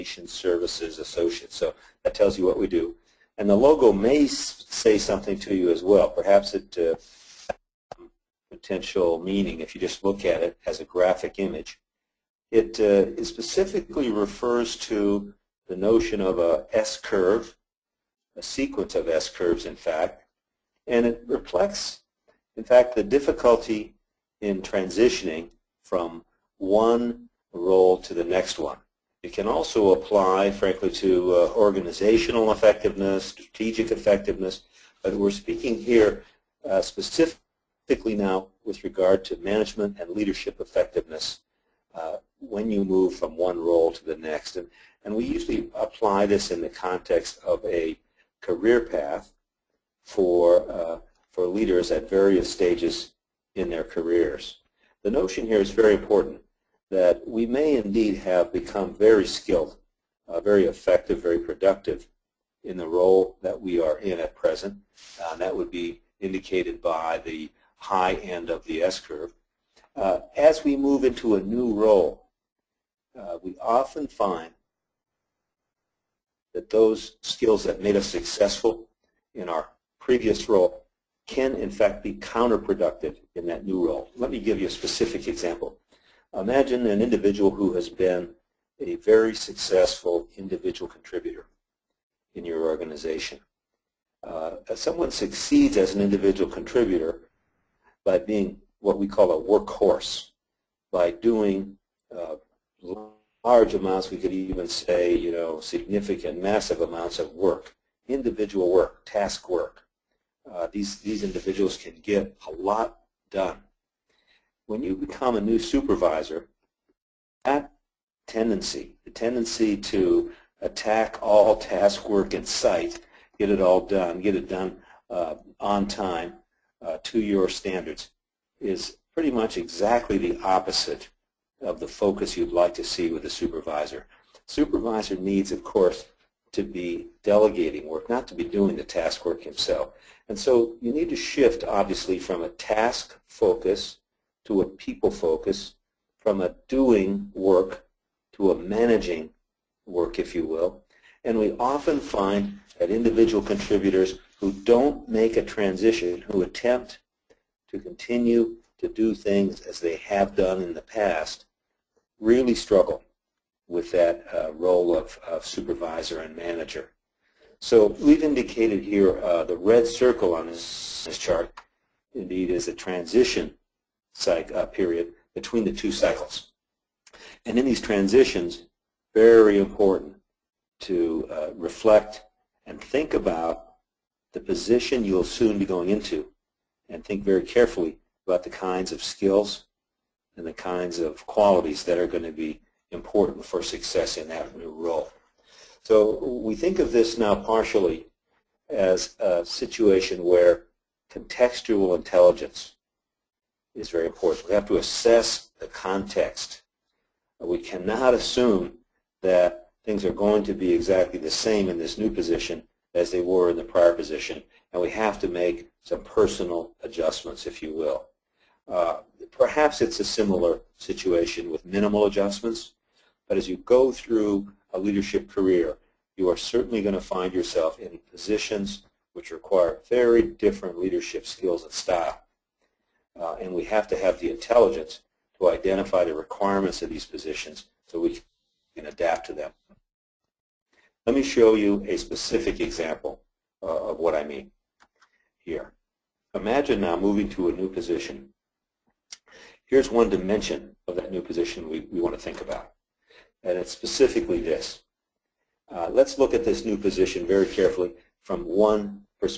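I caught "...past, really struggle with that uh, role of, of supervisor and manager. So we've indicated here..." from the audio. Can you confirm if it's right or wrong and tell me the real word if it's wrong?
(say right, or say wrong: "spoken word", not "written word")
right.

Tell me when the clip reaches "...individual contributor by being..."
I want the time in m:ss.
1:36.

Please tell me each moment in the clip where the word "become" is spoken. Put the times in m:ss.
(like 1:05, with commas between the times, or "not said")
0:58, 1:54.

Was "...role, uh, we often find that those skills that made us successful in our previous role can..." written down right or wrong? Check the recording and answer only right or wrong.
right.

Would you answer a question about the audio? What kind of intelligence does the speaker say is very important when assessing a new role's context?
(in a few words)
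contextual intelligence.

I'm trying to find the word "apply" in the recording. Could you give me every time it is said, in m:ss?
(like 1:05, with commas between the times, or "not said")
0:29, 0:45.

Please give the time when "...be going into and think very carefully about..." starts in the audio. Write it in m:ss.
3:05.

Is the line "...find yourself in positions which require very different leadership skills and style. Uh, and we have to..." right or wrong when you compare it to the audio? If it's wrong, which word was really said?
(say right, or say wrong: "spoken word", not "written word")
right.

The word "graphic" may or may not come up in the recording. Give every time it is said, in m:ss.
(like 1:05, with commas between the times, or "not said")
0:10.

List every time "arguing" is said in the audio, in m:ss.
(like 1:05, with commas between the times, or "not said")
not said.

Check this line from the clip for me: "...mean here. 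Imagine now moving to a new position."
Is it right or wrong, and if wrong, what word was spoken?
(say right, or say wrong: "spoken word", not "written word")
right.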